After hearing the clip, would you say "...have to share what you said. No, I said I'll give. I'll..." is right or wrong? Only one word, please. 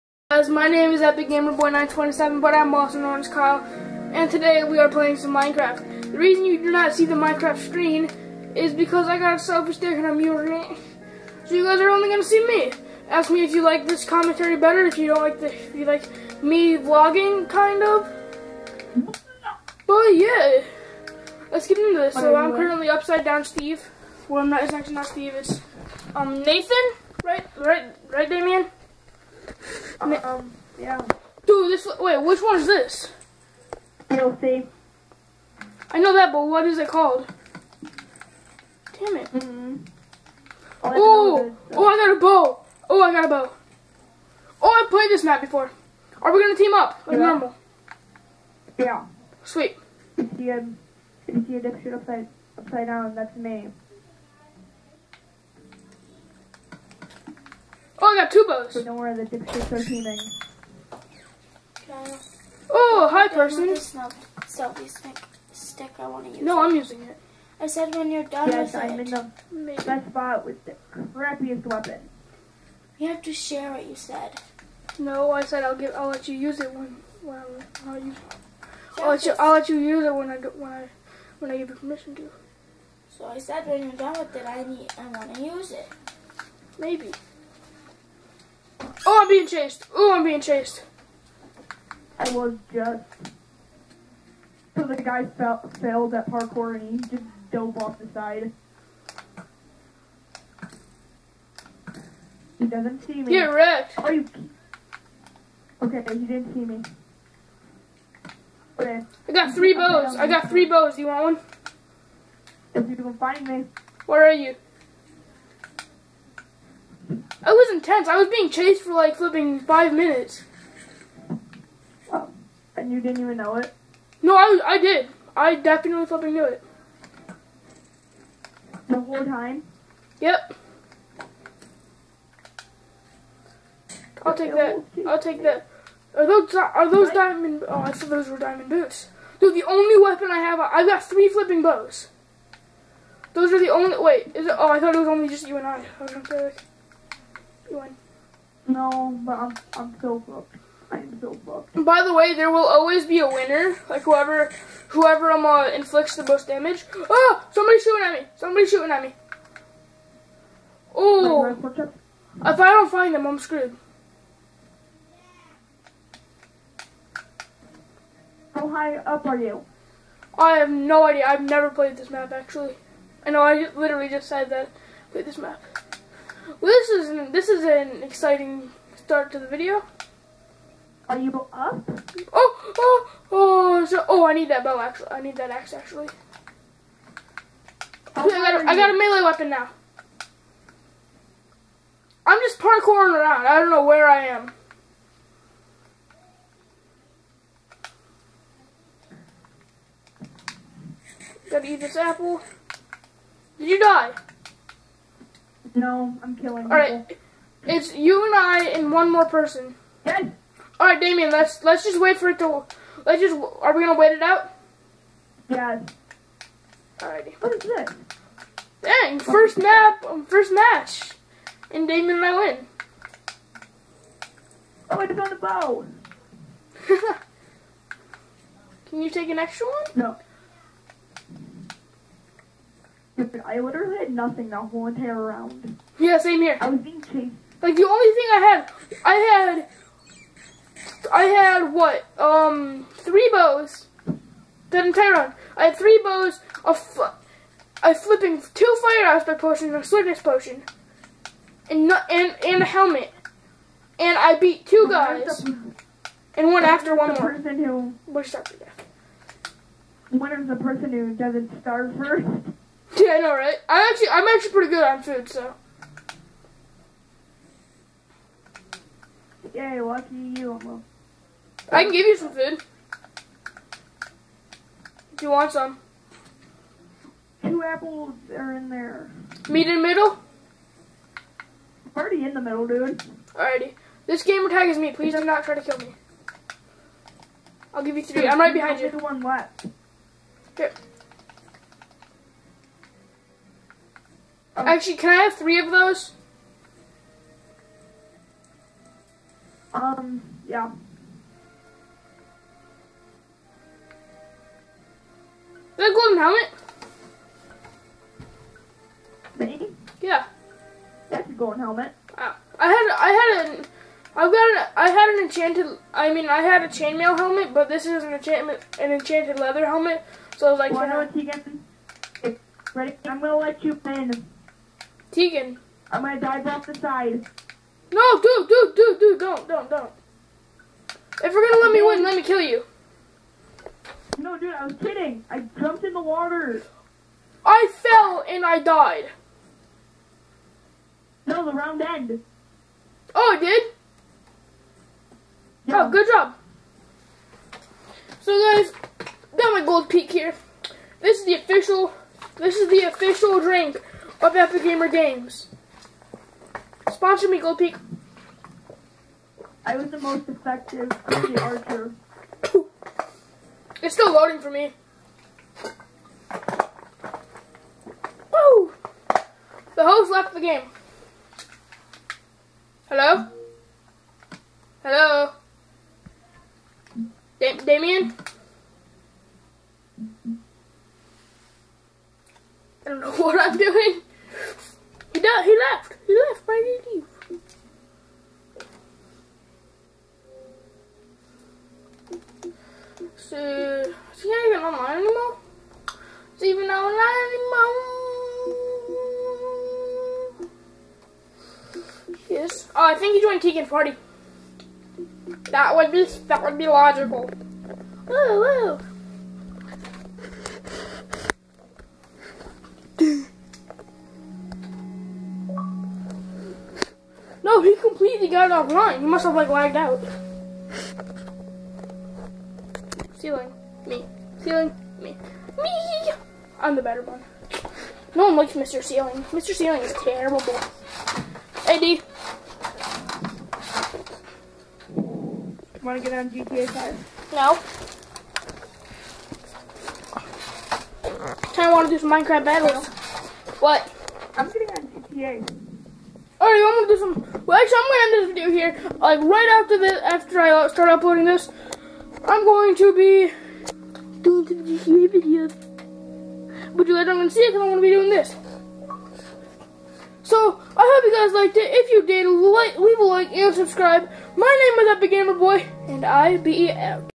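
right.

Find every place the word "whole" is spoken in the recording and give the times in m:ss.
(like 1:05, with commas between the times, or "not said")
2:08, 3:54.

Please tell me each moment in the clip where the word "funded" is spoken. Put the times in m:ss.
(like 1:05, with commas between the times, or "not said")
not said.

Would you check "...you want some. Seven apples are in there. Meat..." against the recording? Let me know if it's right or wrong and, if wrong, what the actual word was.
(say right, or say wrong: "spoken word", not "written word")
wrong: "Two", not "Seven".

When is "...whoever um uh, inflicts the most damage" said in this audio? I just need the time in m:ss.
2:34.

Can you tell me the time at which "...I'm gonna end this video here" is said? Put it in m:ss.
7:27.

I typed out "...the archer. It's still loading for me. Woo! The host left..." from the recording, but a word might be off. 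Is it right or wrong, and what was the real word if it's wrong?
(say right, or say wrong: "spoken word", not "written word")
right.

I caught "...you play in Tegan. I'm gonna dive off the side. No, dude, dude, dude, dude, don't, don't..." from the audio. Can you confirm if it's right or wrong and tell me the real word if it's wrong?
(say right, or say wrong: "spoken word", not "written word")
right.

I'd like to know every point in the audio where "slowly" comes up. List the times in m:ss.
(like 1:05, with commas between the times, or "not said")
not said.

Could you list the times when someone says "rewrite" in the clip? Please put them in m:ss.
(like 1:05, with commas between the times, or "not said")
not said.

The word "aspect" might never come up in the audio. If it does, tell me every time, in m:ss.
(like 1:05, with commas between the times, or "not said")
4:09.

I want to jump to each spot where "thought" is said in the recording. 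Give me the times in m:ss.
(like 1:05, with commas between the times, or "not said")
2:17, 2:24.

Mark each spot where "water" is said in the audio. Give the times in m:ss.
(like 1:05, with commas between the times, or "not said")
5:36.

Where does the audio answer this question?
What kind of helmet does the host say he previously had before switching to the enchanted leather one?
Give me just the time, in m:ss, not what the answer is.
5:16.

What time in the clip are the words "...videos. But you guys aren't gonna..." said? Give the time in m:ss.
7:35.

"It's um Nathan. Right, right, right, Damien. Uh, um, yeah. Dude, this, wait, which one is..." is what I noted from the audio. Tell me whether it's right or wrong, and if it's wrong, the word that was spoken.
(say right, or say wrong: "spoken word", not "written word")
right.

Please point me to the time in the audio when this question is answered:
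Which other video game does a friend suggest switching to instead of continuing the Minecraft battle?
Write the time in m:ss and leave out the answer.
7:16.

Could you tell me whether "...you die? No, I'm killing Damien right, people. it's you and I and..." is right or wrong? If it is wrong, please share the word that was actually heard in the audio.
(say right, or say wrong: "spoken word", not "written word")
wrong: "All", not "Damien".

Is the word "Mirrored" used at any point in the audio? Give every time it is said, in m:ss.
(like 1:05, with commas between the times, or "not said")
not said.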